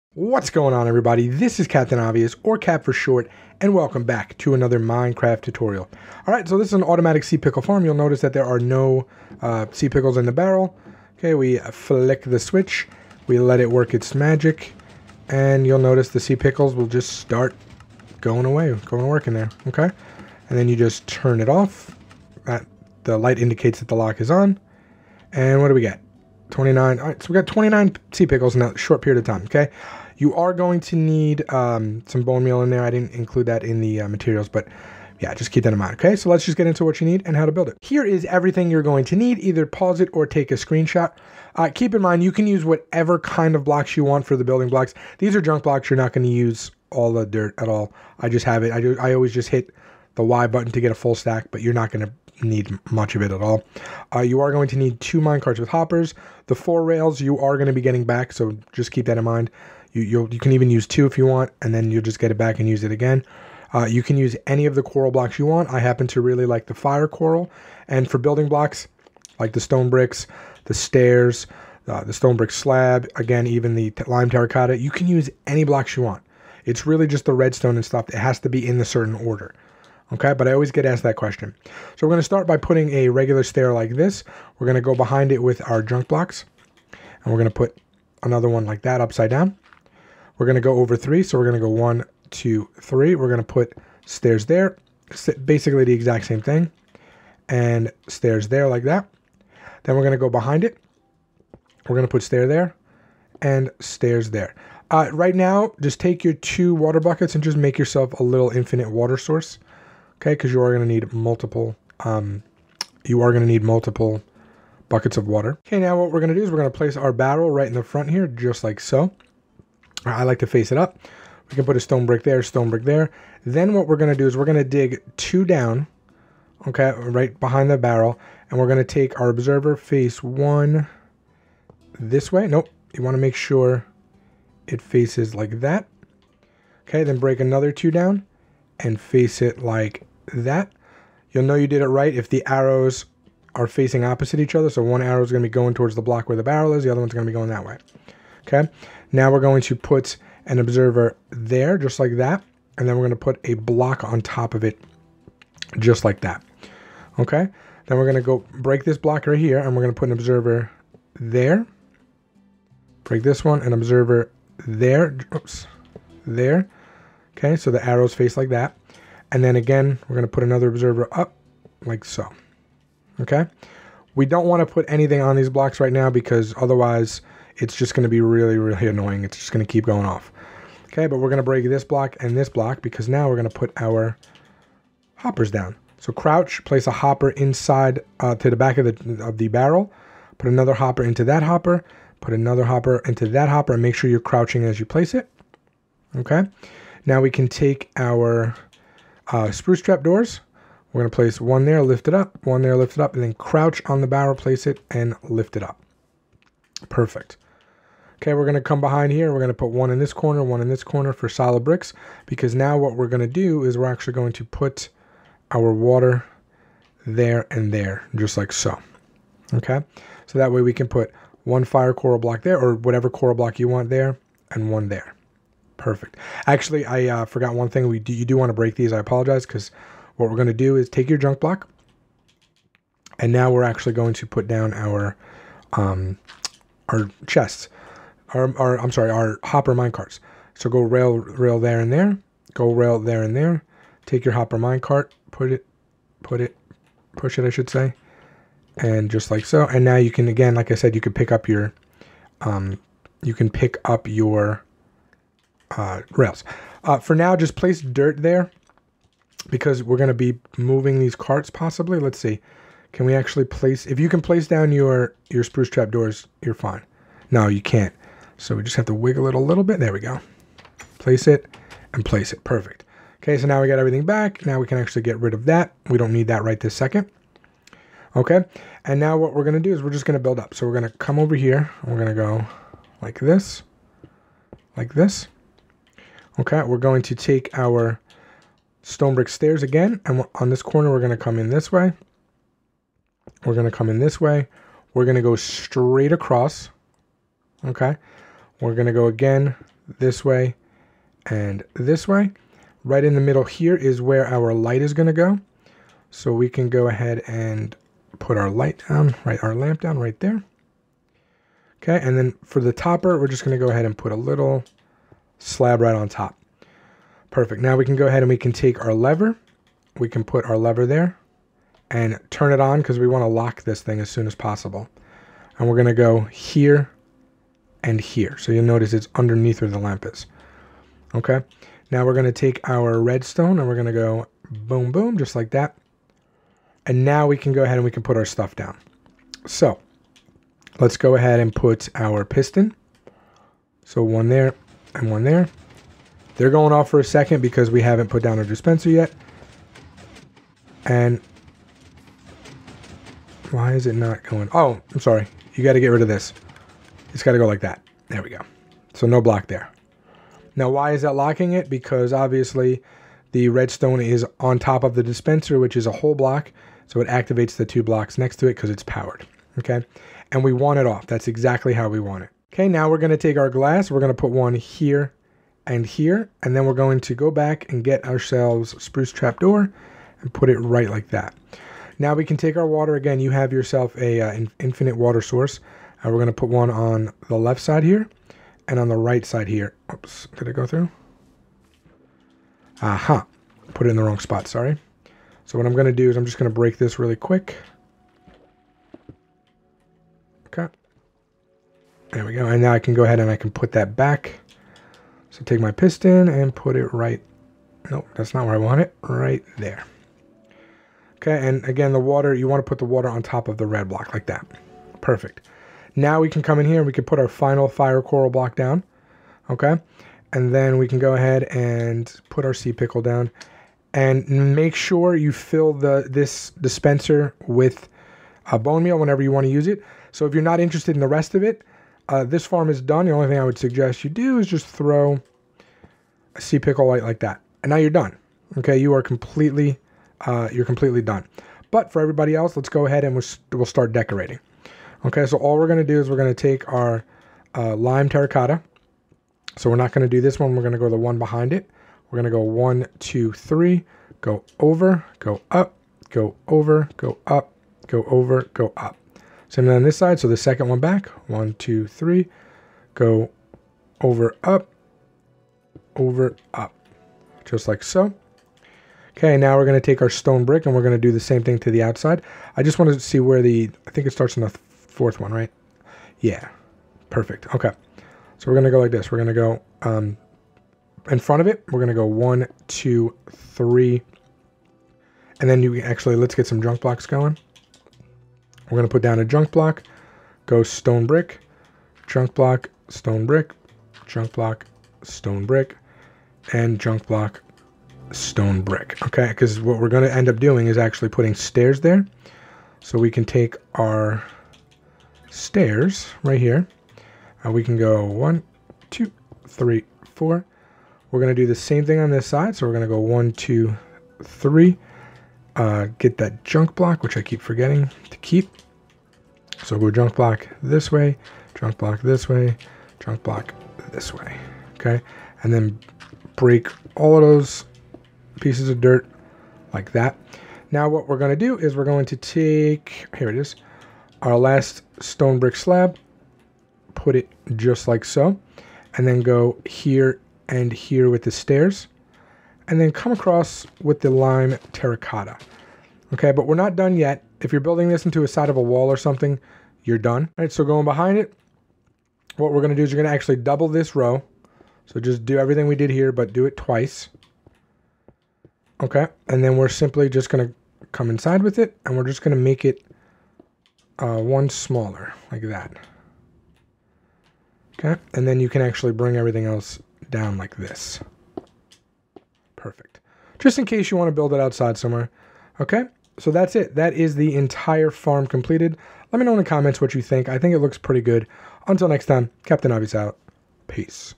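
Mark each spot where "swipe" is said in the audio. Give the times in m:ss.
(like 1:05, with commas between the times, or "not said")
not said.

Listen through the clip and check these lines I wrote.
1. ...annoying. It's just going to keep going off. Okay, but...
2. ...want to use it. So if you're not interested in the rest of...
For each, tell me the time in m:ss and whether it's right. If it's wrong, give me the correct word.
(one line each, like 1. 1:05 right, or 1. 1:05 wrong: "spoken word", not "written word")
1. 2:58 right
2. 7:09 right.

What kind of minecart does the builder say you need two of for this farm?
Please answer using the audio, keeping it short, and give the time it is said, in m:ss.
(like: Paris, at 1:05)
minecarts with hoppers, at 0:55.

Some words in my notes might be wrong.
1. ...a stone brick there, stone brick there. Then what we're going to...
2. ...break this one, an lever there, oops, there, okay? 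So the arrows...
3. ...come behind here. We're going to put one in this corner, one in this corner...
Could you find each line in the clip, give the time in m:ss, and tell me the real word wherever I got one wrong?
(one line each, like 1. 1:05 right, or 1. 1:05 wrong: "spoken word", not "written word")
1. 2:01 right
2. 2:43 wrong: "observer", not "lever"
3. 3:28 right.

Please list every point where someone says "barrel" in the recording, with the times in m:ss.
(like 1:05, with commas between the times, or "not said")
0:10, 1:57, 2:07, 2:26, 3:09, 3:24.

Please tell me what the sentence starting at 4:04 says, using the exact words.
Take your hopper minecart, put it, put it, push it, I should say, and just like so.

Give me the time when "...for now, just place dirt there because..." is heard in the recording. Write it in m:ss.
4:16.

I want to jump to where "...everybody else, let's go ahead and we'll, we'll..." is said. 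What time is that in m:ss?
7:22.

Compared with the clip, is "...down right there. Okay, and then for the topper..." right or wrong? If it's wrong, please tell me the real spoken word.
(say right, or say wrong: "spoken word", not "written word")
right.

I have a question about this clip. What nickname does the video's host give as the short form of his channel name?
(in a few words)
Cap.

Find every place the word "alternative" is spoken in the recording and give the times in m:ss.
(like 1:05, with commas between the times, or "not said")
not said.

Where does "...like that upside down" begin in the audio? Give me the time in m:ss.
1:28.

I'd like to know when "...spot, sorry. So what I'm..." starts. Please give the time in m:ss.
6:34.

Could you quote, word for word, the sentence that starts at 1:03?
Uh, you can use any of the coral blocks you want.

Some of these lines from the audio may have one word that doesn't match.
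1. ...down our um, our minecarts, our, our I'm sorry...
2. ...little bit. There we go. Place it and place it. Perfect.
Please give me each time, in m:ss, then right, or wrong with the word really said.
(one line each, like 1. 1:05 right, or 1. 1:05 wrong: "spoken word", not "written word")
1. 3:54 wrong: "chests", not "minecarts"
2. 4:29 right.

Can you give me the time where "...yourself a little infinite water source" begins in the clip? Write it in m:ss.
1:47.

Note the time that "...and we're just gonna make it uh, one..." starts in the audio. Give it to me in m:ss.
9:21.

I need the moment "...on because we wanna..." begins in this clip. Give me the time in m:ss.
5:22.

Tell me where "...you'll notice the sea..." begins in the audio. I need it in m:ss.
0:15.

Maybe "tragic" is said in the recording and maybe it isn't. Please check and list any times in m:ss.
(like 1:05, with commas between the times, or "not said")
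not said.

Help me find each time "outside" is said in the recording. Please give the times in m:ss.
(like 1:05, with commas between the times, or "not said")
7:51, 9:34.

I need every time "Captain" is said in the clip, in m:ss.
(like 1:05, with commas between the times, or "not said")
0:01, 9:42.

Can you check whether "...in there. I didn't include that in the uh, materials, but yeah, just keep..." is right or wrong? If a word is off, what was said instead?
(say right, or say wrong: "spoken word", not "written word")
right.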